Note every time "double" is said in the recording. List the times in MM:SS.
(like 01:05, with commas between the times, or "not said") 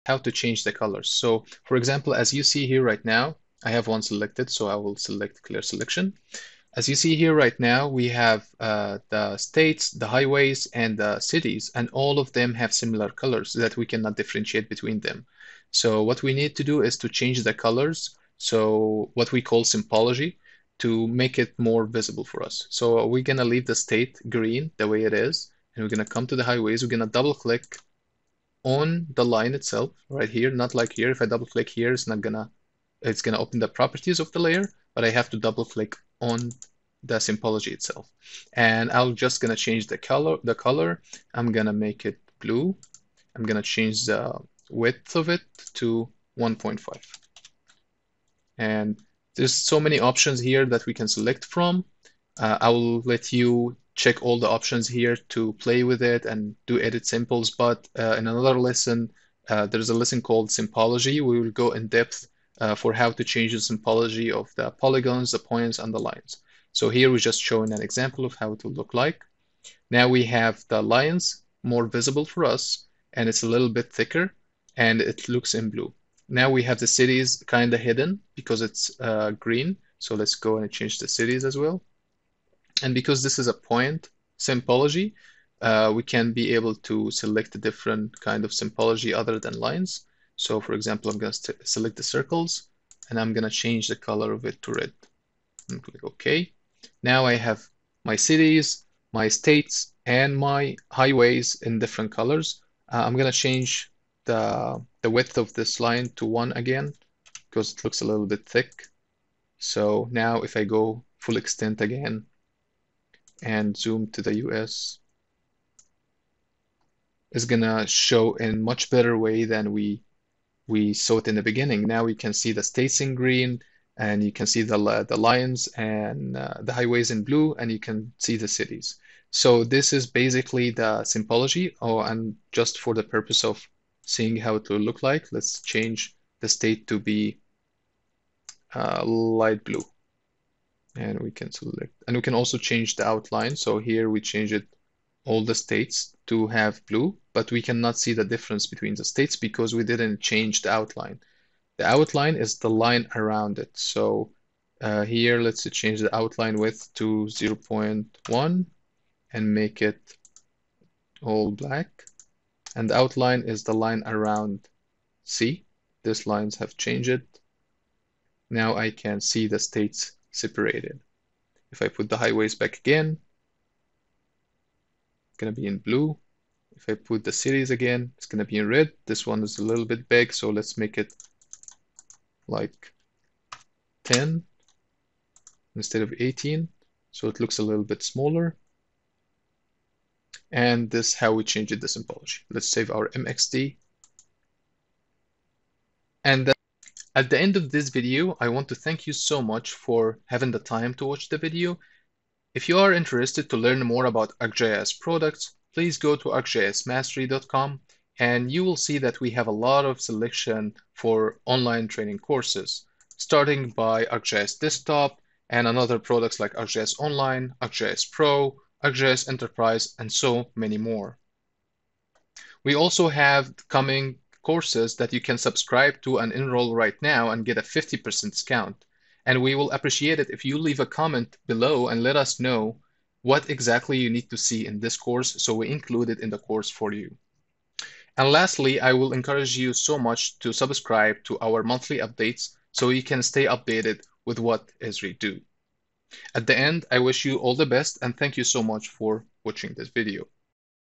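00:27, 00:31, 00:35.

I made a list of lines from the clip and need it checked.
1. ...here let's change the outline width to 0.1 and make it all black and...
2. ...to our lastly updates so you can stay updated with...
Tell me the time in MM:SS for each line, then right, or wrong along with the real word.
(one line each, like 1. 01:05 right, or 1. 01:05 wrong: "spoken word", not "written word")
1. 02:35 right
2. 04:01 wrong: "monthly", not "lastly".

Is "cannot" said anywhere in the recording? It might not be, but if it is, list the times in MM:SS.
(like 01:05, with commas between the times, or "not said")
00:13, 02:27.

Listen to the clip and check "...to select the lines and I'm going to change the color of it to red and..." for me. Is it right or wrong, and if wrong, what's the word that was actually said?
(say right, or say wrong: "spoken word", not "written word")
wrong: "circles", not "lines".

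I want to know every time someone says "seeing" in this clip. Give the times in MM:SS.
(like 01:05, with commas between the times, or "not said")
02:14.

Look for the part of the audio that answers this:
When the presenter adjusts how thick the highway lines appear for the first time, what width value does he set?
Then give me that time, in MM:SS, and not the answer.
00:46.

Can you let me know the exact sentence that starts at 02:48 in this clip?
now I can see the states separated.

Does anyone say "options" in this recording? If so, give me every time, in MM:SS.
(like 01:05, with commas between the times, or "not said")
00:49, 00:54.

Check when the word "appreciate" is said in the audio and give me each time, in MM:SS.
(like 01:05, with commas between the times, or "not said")
03:49.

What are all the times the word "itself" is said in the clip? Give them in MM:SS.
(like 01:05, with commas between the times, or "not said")
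00:29, 00:37.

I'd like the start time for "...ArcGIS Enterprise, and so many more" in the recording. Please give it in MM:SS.
03:38.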